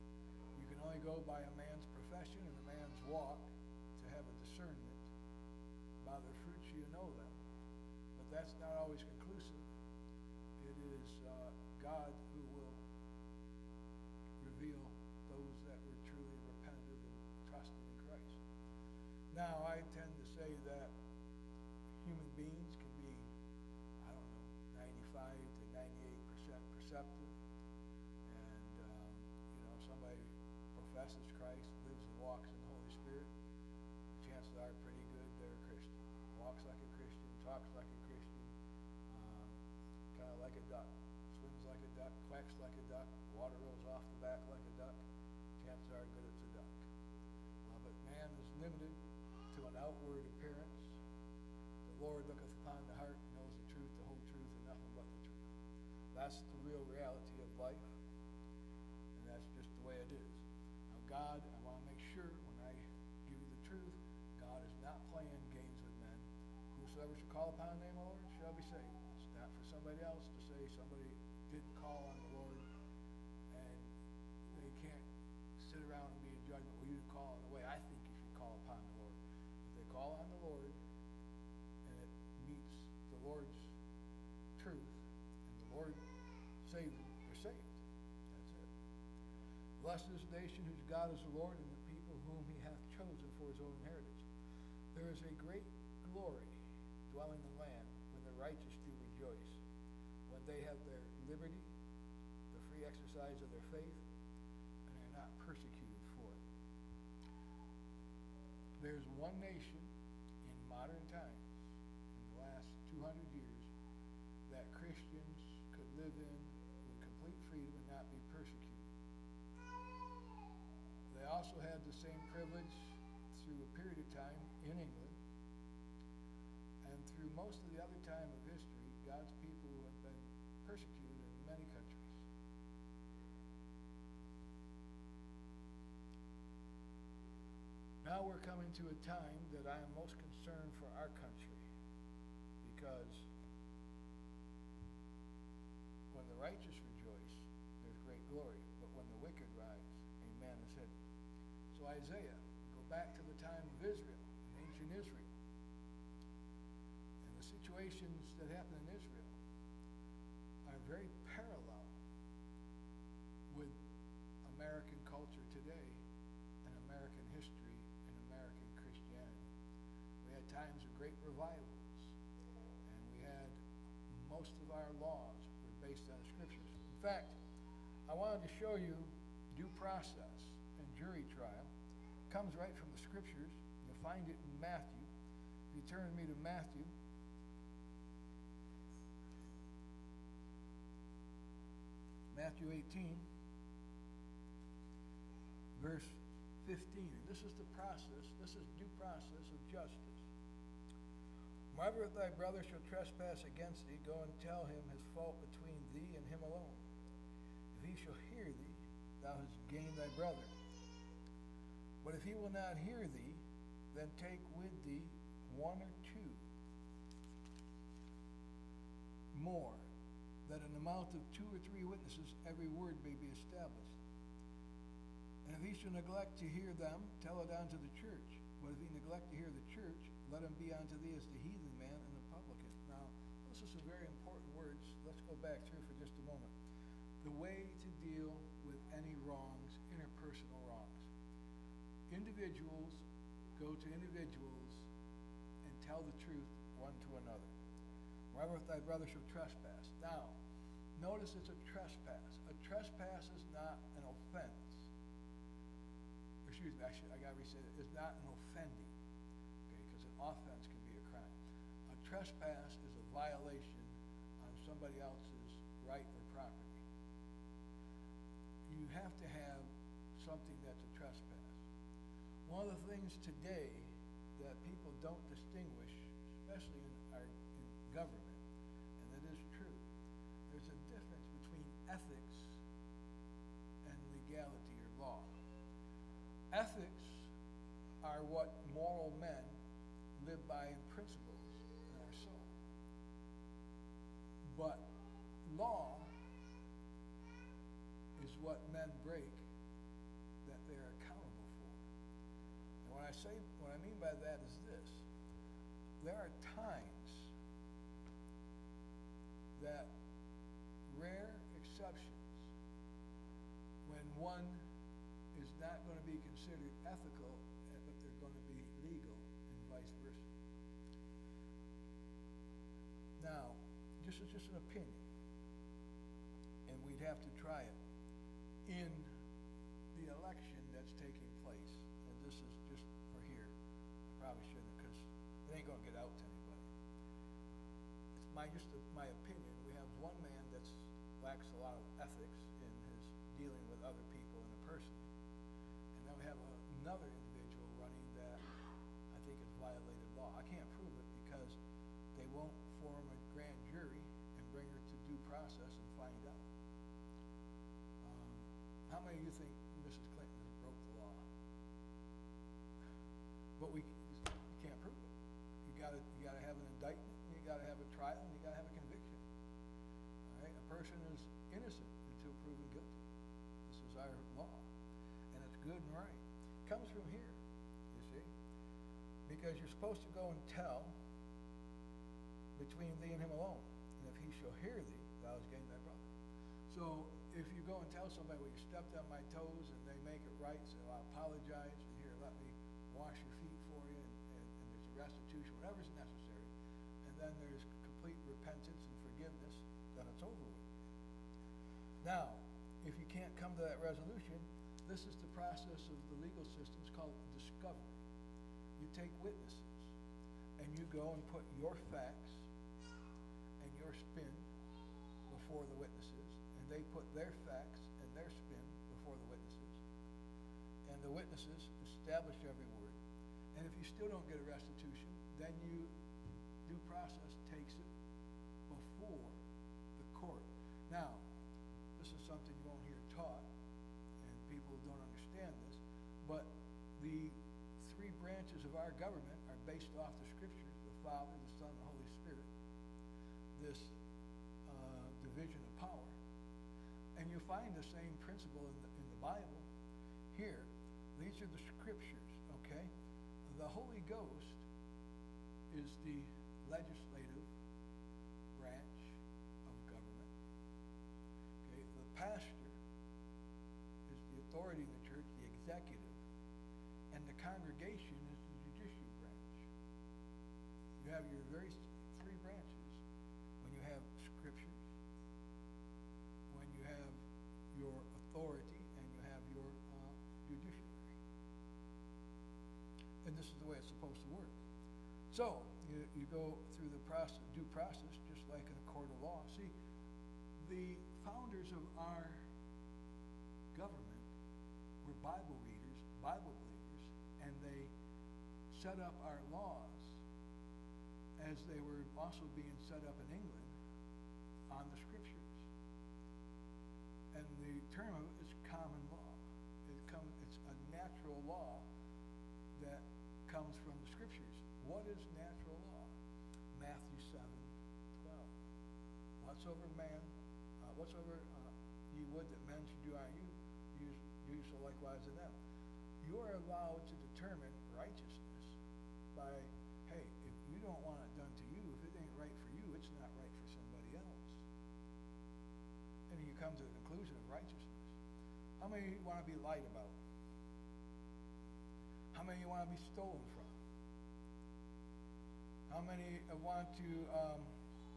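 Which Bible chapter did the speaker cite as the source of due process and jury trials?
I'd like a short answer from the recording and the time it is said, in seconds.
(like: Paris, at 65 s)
Matthew 18, at 192 s.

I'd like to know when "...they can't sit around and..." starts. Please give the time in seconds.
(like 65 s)
74 s.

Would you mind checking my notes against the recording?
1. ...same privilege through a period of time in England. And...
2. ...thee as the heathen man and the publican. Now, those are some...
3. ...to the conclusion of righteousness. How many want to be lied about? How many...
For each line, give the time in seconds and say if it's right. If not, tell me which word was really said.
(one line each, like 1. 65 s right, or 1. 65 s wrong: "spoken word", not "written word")
1. 122 s right
2. 231 s right
3. 536 s right.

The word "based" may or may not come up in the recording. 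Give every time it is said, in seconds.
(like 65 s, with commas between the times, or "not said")
175 s, 439 s.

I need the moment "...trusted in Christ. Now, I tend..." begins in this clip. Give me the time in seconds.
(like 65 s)
17 s.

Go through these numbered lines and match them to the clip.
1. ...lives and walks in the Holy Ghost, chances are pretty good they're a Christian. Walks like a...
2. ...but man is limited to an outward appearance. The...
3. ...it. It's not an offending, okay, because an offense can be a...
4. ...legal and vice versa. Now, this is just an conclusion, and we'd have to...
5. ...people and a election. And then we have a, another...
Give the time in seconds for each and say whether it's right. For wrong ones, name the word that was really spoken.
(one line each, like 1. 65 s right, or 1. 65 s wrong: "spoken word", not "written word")
1. 31 s wrong: "Spirit", not "Ghost"
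2. 47 s right
3. 257 s right
4. 318 s wrong: "opinion", not "conclusion"
5. 344 s wrong: "person", not "election".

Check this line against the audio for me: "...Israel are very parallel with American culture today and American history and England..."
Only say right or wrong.
wrong.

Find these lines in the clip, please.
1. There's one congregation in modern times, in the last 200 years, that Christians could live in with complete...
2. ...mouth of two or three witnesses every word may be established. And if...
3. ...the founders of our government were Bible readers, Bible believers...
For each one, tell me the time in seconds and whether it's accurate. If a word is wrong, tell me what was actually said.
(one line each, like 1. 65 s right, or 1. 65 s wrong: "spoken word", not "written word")
1. 108 s wrong: "nation", not "congregation"
2. 220 s right
3. 490 s right.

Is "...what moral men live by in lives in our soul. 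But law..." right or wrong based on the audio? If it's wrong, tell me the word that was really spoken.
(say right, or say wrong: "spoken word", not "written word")
wrong: "principles", not "lives".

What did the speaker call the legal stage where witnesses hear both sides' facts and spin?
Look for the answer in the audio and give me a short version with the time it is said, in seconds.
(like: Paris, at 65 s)
discovery, at 407 s.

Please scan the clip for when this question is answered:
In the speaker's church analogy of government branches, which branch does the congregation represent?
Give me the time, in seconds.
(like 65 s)
468 s.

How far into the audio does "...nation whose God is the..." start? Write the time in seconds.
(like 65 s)
90 s.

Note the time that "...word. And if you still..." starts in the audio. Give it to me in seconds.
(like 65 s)
422 s.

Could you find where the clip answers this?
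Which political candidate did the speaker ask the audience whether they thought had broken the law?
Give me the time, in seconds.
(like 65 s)
359 s.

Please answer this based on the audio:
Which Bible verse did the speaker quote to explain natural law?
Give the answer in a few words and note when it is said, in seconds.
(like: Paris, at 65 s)
Matthew 7:12, at 516 s.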